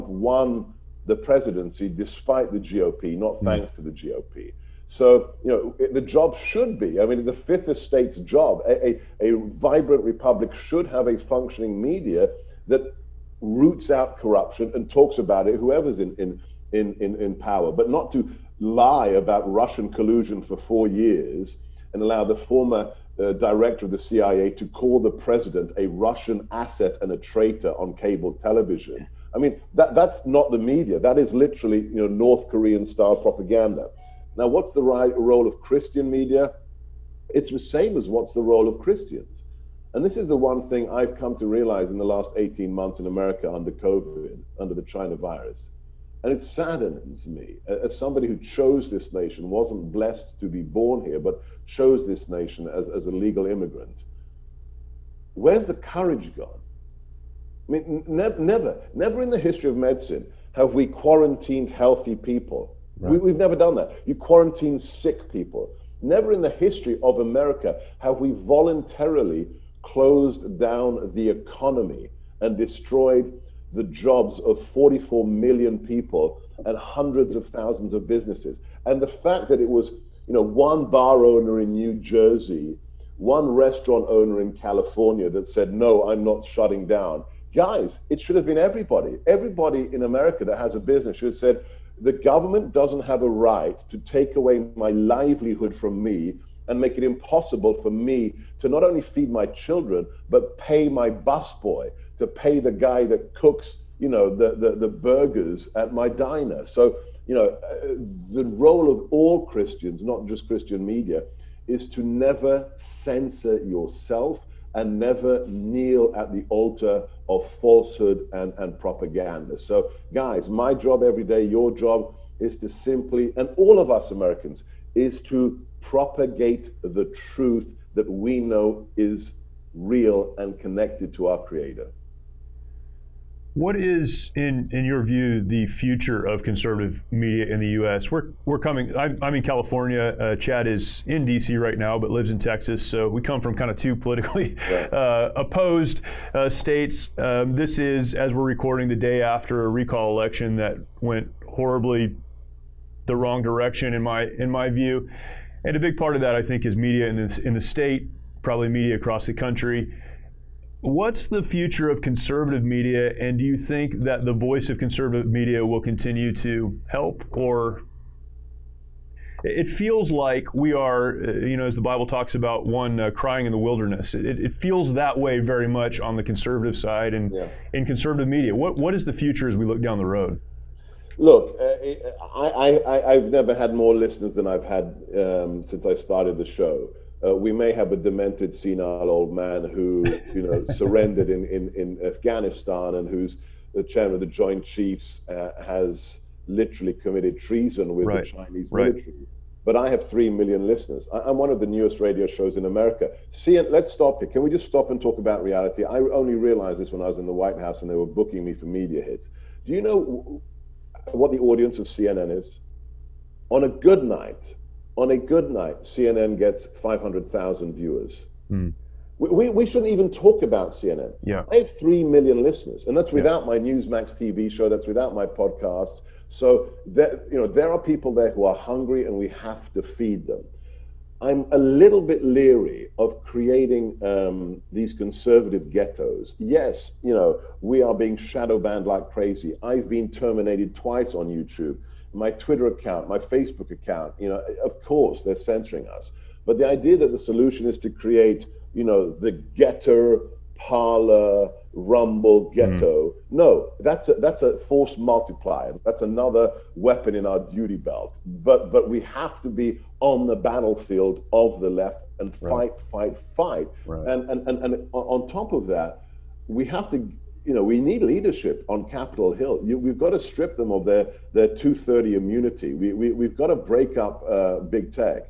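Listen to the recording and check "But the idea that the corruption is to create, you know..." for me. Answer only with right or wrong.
wrong.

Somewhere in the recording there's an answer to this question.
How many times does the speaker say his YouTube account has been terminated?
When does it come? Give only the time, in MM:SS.
04:00.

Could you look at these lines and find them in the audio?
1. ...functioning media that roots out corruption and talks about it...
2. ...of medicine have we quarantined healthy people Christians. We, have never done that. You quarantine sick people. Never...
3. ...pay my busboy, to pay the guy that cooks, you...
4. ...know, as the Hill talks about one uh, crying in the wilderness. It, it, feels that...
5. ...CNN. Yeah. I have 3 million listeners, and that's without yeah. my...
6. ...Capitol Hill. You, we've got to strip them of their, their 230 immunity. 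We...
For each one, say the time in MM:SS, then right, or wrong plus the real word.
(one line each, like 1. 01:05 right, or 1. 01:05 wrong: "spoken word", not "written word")
1. 00:11 right
2. 00:59 wrong: "Right", not "Christians"
3. 01:40 right
4. 02:51 wrong: "Bible", not "Hill"
5. 03:40 right
6. 04:28 right.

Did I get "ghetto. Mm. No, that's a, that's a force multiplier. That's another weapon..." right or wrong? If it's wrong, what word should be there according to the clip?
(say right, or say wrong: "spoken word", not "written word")
right.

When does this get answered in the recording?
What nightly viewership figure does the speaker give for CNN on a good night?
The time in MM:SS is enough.
03:36.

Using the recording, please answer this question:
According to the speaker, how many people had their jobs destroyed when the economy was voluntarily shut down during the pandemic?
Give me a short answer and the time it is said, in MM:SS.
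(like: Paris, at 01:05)
44 million, at 01:14.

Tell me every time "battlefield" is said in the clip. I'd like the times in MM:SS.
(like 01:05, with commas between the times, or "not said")
04:20.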